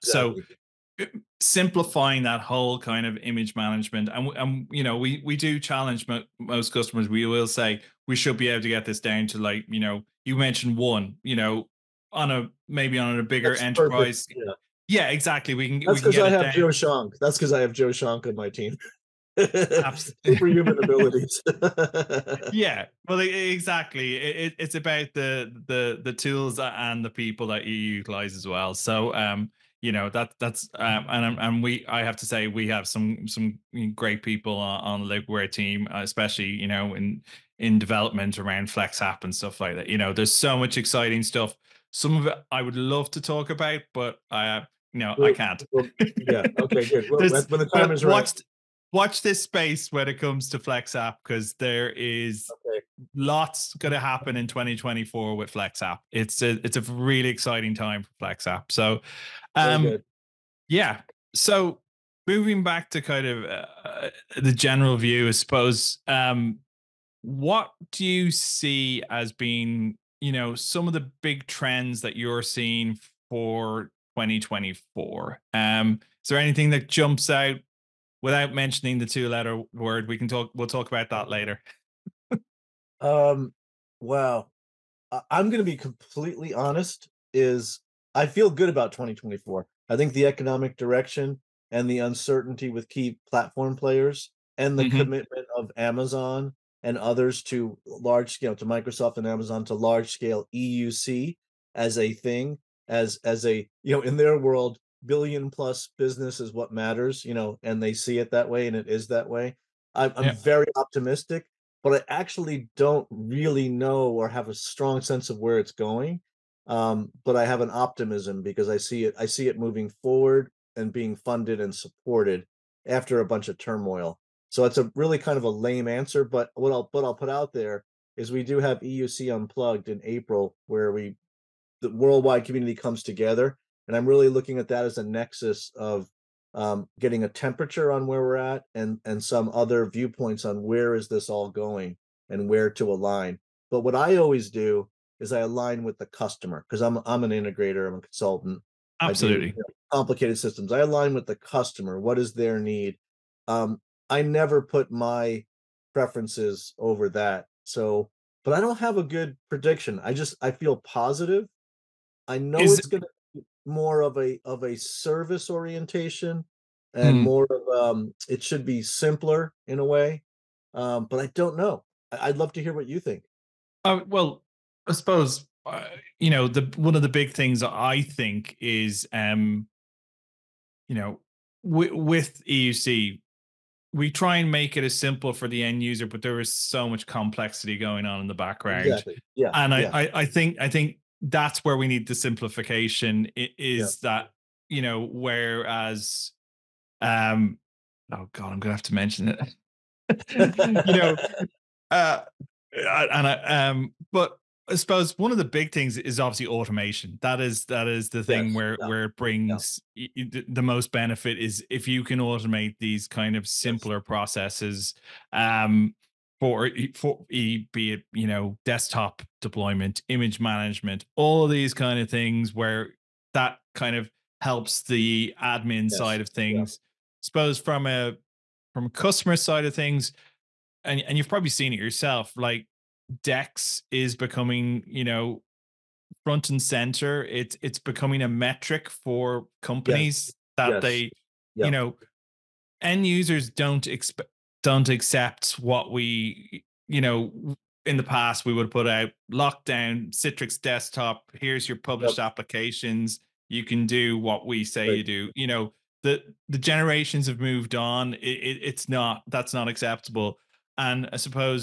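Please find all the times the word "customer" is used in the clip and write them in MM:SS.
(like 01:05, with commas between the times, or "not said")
00:06, 02:26, 02:31, 03:48.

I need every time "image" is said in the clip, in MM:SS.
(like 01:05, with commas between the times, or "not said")
00:03, 03:40.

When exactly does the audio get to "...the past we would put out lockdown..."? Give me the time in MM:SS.
04:07.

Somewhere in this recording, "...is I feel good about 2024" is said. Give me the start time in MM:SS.
01:27.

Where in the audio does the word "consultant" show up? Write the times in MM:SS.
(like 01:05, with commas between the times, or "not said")
02:28.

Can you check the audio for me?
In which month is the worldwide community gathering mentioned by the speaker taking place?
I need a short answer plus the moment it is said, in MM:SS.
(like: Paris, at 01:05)
April, at 02:10.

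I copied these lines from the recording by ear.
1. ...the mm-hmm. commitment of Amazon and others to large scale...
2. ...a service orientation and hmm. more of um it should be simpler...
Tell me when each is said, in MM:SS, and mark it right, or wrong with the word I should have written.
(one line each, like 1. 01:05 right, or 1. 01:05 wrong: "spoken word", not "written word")
1. 01:34 right
2. 02:44 right.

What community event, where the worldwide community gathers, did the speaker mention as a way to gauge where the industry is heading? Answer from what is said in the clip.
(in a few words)
EUC Unplugged.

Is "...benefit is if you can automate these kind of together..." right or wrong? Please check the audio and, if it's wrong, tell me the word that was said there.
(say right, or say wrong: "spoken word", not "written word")
wrong: "simpler", not "together".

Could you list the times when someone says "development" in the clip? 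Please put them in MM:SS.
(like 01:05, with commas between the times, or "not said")
00:37.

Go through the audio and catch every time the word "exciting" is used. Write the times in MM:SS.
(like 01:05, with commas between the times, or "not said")
00:40, 00:57.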